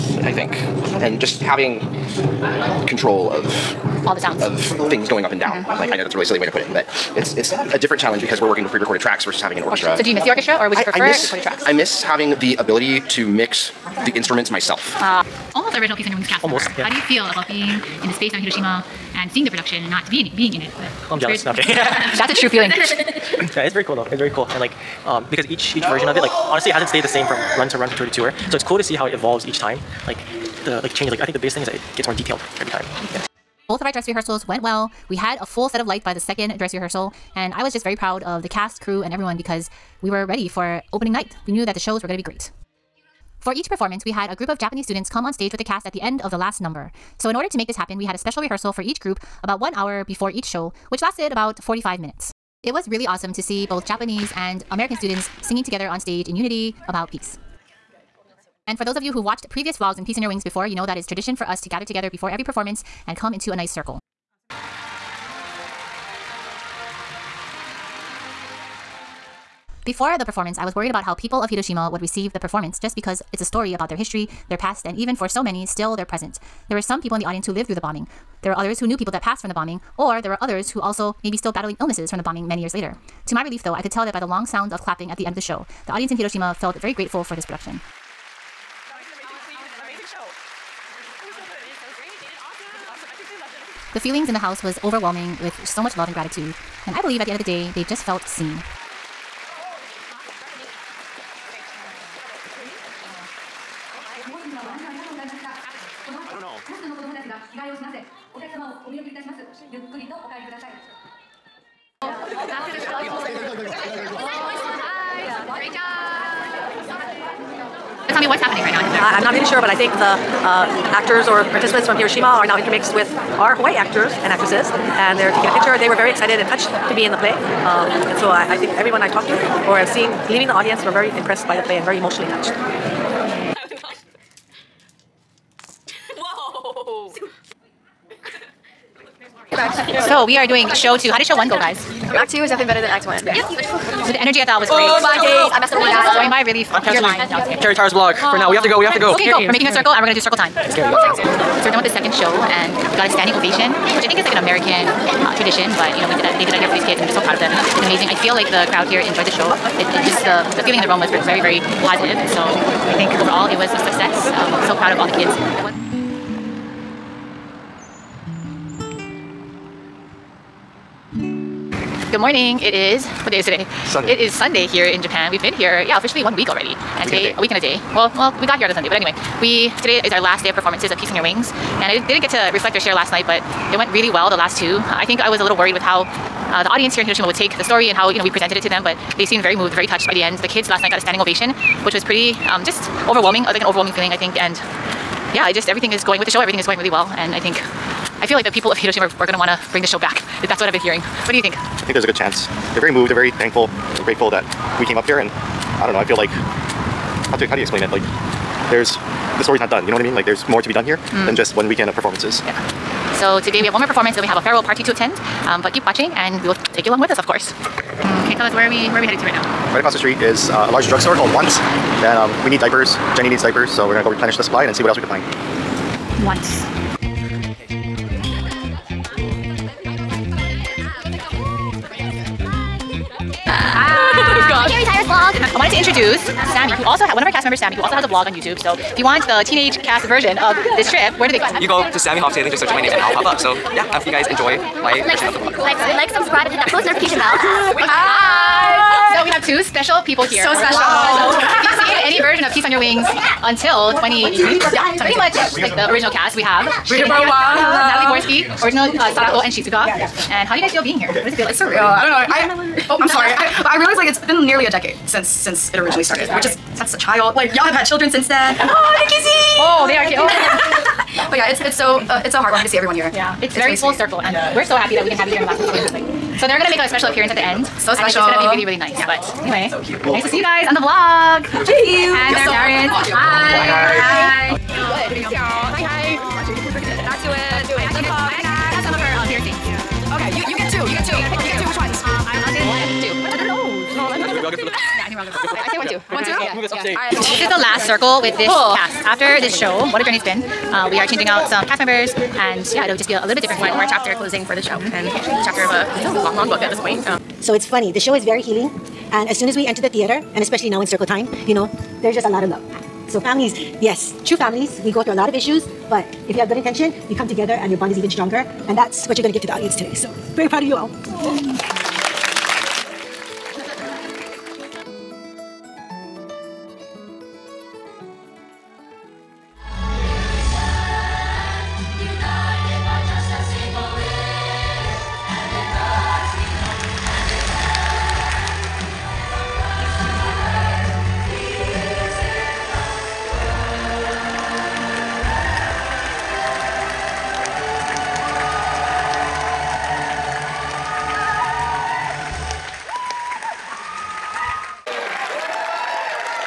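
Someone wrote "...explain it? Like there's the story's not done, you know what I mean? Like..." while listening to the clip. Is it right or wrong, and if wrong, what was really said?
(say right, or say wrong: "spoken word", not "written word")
right.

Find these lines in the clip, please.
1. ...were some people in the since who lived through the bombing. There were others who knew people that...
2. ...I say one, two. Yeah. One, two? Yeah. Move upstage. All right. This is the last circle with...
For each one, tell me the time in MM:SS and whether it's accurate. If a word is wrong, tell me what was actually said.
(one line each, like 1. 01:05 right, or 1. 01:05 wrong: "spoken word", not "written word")
1. 01:16 wrong: "audience", not "since"
2. 04:55 right.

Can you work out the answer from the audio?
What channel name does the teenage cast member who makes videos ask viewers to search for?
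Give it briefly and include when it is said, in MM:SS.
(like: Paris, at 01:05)
Sammy Hoftail, at 04:01.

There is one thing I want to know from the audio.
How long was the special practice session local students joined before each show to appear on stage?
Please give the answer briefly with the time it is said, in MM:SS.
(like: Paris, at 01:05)
45 minutes, at 00:51.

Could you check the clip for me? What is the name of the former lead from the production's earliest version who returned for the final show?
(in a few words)
Natalie Borsky.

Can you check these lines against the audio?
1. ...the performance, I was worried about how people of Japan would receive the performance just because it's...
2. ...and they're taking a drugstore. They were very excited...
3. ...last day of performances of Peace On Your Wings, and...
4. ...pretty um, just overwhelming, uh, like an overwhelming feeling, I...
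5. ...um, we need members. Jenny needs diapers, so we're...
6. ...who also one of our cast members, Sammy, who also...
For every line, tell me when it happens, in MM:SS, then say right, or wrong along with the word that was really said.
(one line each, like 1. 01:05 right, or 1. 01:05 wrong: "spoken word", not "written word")
1. 01:10 wrong: "Hiroshima", not "Japan"
2. 02:05 wrong: "picture", not "drugstore"
3. 03:00 right
4. 03:12 right
5. 03:42 wrong: "diapers", not "members"
6. 03:56 right.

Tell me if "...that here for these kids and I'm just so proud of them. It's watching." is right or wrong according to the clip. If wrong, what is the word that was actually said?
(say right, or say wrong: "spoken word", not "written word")
wrong: "amazing", not "watching".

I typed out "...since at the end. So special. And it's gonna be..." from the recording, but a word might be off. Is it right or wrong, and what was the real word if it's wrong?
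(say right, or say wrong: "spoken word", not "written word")
wrong: "appearance", not "since".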